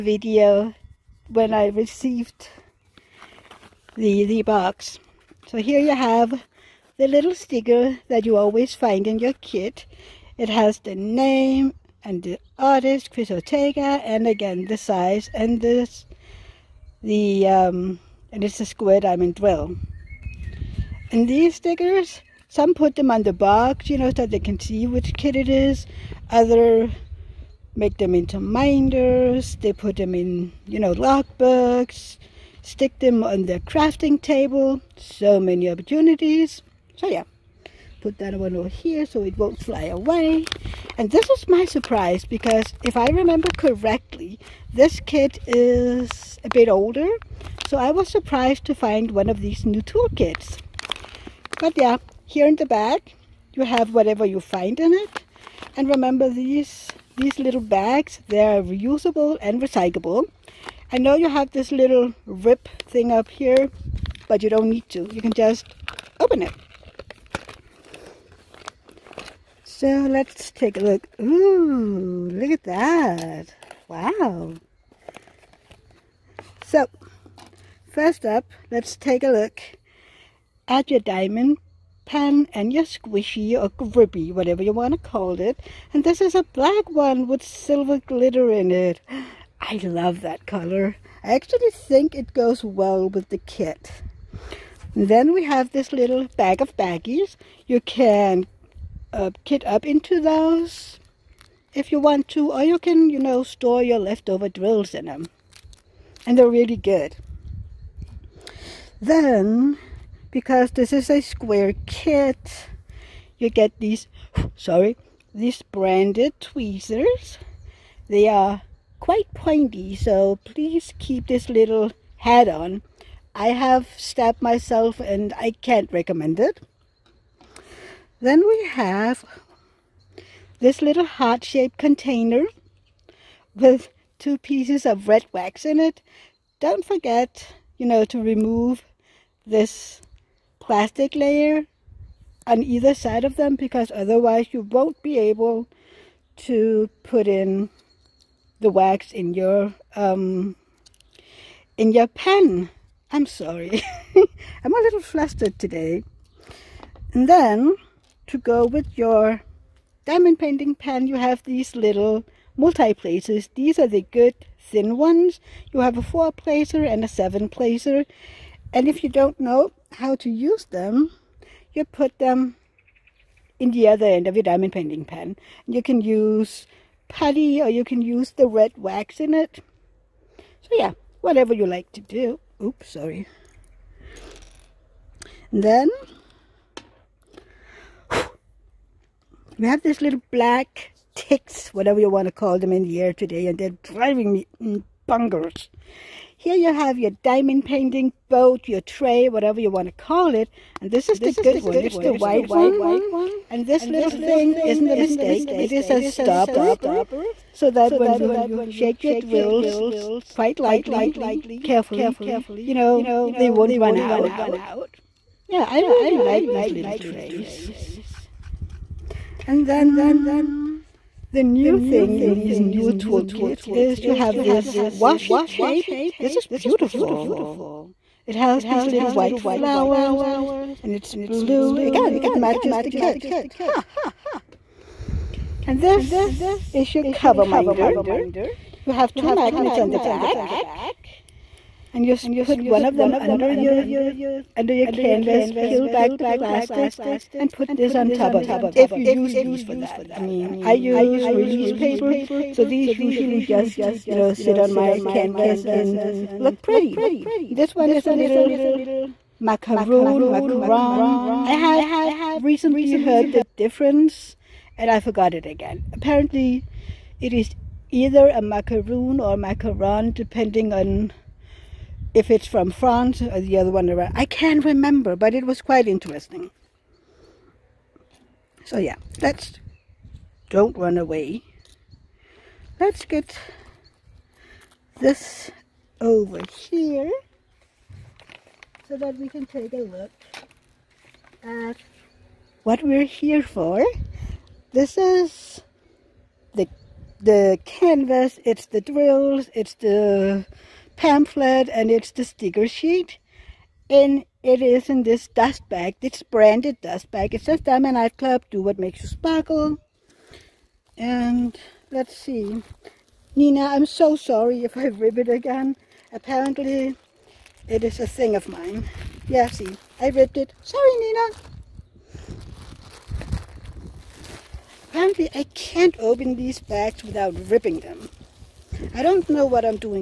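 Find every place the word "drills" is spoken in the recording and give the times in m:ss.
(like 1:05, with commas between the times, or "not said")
0:19, 1:44, 3:29, 4:58.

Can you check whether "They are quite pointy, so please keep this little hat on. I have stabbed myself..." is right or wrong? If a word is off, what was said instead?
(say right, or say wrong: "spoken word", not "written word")
right.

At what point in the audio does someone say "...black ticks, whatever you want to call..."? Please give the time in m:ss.
3:10.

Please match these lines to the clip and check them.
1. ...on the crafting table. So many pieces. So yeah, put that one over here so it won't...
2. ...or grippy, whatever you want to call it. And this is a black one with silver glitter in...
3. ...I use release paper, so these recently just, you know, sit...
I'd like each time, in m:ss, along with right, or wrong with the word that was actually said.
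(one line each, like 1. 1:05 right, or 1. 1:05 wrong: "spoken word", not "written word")
1. 0:33 wrong: "opportunities", not "pieces"
2. 1:23 right
3. 4:10 wrong: "usually", not "recently".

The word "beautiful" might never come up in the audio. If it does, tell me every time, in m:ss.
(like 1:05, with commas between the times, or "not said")
3:46.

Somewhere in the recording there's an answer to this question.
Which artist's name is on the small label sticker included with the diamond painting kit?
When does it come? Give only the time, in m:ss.
0:13.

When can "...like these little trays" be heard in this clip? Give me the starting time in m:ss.
3:36.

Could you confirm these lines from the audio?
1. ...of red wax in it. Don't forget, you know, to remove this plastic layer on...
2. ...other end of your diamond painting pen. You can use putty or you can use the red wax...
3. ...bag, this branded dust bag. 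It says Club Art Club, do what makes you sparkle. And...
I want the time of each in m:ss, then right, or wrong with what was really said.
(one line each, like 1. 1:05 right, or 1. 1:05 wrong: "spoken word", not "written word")
1. 2:14 right
2. 2:53 right
3. 5:05 wrong: "Diamond", not "Club".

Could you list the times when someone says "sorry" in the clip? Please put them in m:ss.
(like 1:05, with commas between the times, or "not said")
1:54, 2:33, 3:02, 5:14, 5:20.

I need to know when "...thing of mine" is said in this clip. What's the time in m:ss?
5:18.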